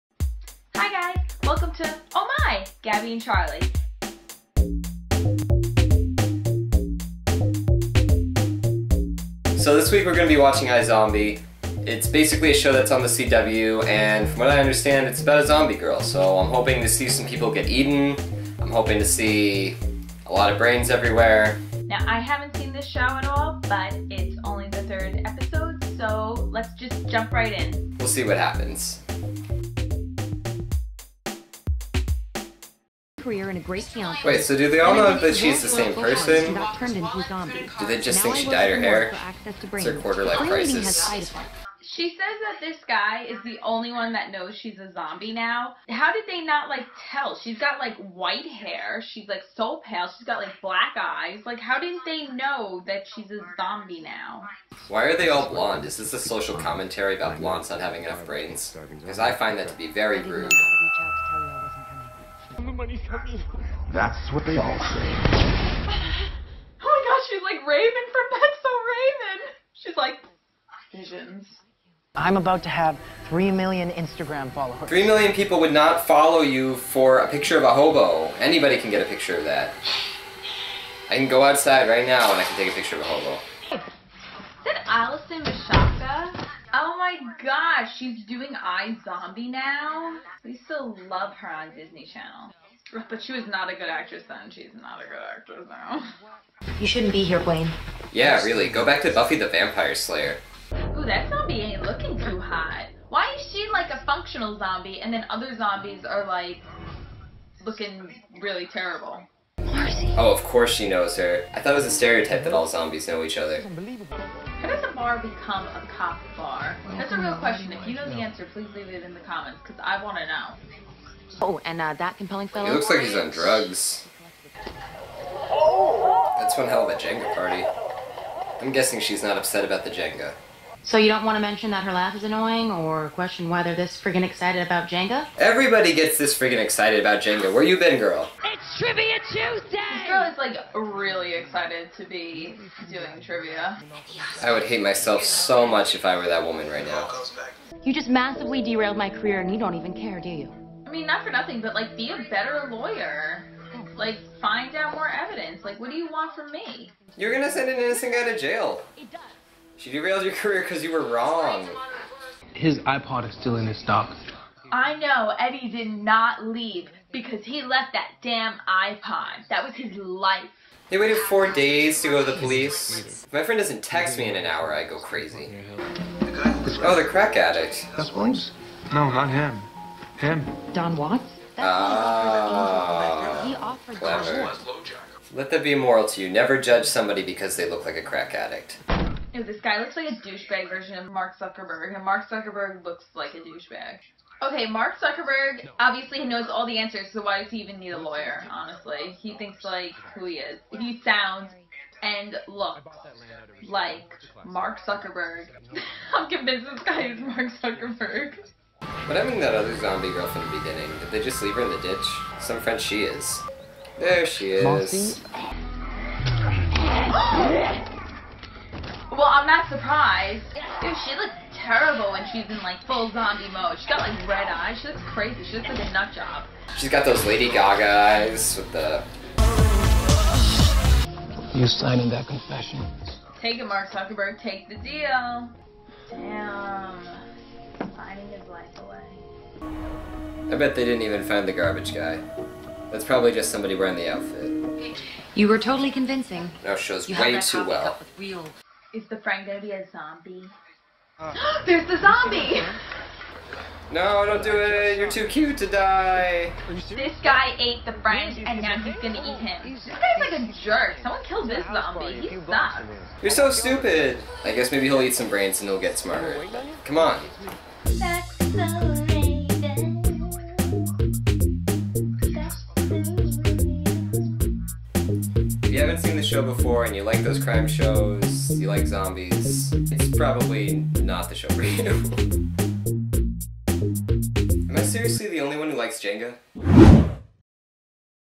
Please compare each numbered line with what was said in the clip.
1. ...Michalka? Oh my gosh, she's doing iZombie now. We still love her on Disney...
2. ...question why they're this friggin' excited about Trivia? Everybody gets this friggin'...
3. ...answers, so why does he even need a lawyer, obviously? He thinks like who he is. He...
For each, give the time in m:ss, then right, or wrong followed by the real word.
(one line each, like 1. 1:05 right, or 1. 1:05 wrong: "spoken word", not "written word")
1. 1:25 right
2. 2:13 wrong: "Jenga", not "Trivia"
3. 3:16 wrong: "honestly", not "obviously".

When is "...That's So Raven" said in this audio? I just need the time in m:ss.
1:08.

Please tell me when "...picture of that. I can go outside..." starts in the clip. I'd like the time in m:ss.
1:19.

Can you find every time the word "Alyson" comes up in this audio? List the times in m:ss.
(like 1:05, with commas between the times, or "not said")
1:24.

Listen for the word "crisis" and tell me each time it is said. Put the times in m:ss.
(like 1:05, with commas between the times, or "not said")
0:40.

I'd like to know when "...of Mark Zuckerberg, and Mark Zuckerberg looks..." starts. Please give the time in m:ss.
3:10.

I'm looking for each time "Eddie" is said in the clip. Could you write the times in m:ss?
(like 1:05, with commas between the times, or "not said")
2:45.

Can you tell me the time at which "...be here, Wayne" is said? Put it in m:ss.
1:37.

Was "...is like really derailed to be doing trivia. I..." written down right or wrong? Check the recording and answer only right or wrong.
wrong.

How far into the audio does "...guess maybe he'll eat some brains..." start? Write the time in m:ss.
4:24.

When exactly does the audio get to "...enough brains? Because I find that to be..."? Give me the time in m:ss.
0:58.